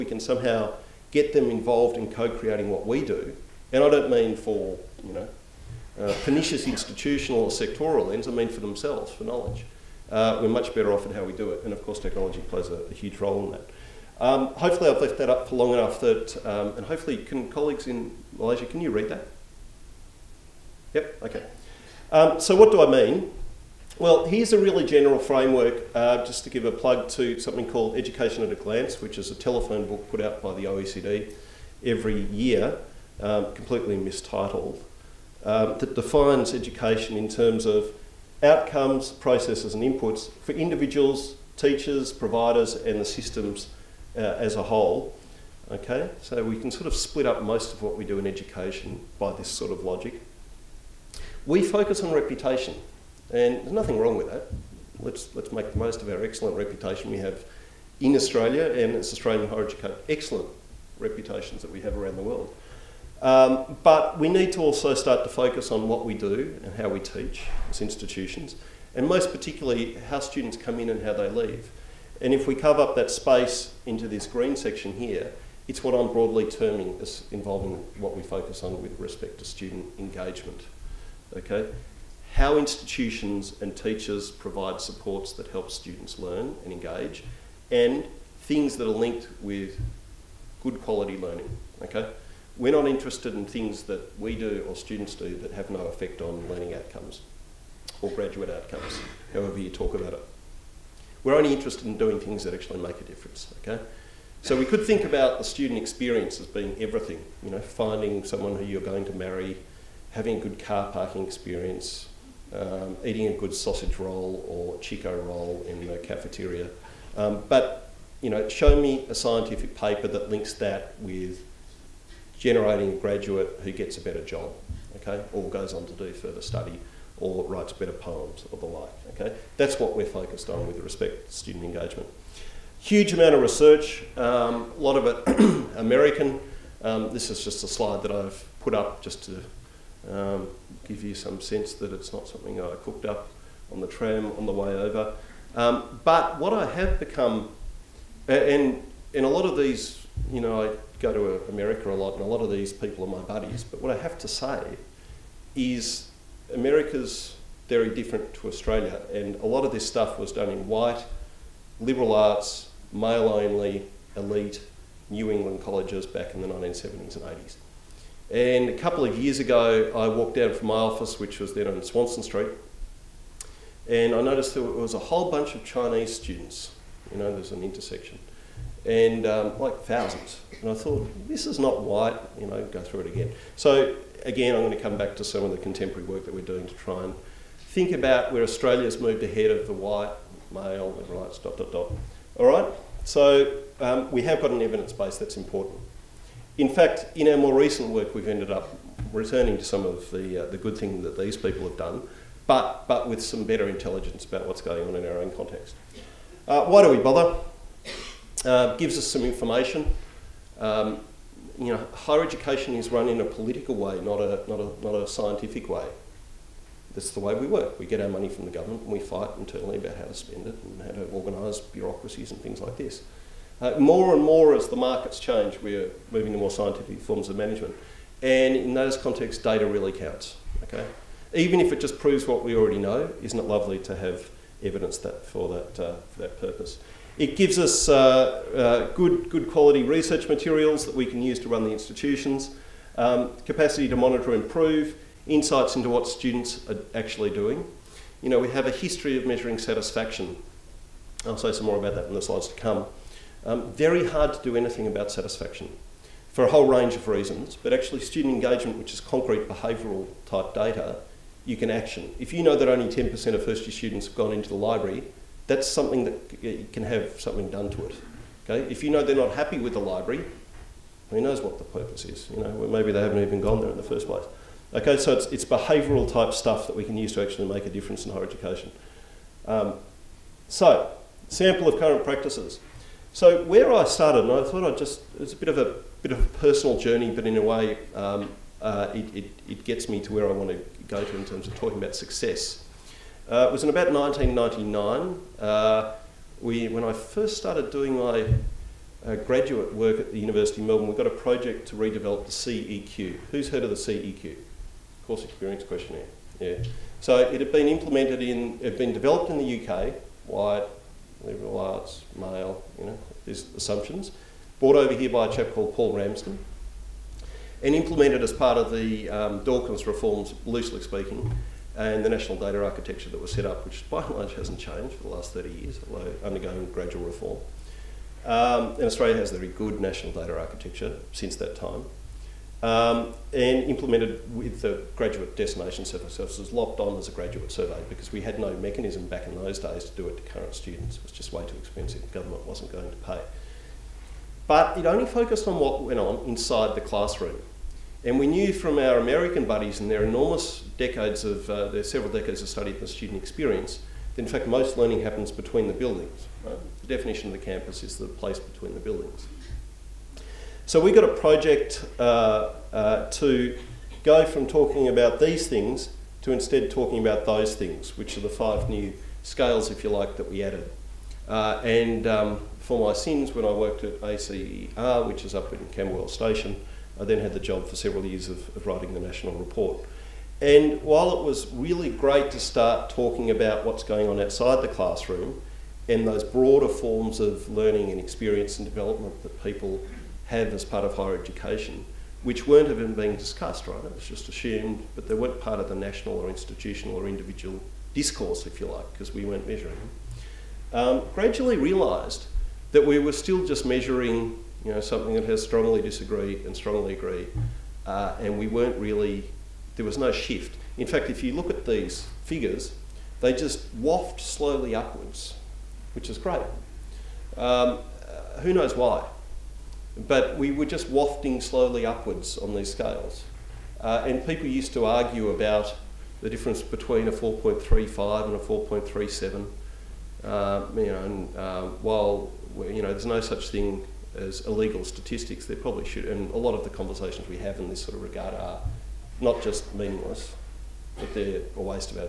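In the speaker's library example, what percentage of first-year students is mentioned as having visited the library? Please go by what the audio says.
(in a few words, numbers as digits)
10%.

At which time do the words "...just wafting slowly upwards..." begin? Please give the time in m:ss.
7:00.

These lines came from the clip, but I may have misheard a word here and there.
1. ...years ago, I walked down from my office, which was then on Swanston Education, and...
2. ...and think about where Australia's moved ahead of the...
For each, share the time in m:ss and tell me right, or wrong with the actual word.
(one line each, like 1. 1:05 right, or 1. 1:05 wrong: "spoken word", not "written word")
1. 2:49 wrong: "Street", not "Education"
2. 3:07 right.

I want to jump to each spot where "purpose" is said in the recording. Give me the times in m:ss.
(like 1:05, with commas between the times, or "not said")
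3:56, 4:31.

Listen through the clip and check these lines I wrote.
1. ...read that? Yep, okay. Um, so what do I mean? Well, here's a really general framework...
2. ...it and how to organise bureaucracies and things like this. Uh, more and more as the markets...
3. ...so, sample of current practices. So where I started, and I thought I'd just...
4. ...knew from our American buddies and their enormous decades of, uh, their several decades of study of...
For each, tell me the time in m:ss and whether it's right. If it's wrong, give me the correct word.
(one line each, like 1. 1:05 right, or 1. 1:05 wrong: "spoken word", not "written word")
1. 0:18 right
2. 3:40 right
3. 4:40 right
4. 5:48 right.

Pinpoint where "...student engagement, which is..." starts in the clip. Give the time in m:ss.
4:17.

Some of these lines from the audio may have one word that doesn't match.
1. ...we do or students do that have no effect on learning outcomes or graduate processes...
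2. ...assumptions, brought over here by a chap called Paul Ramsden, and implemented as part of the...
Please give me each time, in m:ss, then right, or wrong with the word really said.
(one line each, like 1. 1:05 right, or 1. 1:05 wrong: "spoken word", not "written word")
1. 1:34 wrong: "outcomes", not "processes"
2. 5:13 right.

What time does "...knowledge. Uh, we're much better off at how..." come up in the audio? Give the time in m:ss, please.
0:09.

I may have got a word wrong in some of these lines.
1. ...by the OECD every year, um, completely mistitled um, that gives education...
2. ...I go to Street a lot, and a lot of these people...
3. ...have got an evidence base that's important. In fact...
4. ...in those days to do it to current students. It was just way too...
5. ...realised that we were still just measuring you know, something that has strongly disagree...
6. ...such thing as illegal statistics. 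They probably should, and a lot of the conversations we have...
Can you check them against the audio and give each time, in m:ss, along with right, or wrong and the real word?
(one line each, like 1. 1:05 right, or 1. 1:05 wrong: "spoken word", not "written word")
1. 0:30 wrong: "defines", not "gives"
2. 2:30 wrong: "America", not "Street"
3. 3:14 right
4. 5:39 right
5. 6:41 right
6. 7:13 right.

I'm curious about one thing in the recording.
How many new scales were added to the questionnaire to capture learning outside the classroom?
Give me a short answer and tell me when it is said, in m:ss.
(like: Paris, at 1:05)
5, at 6:08.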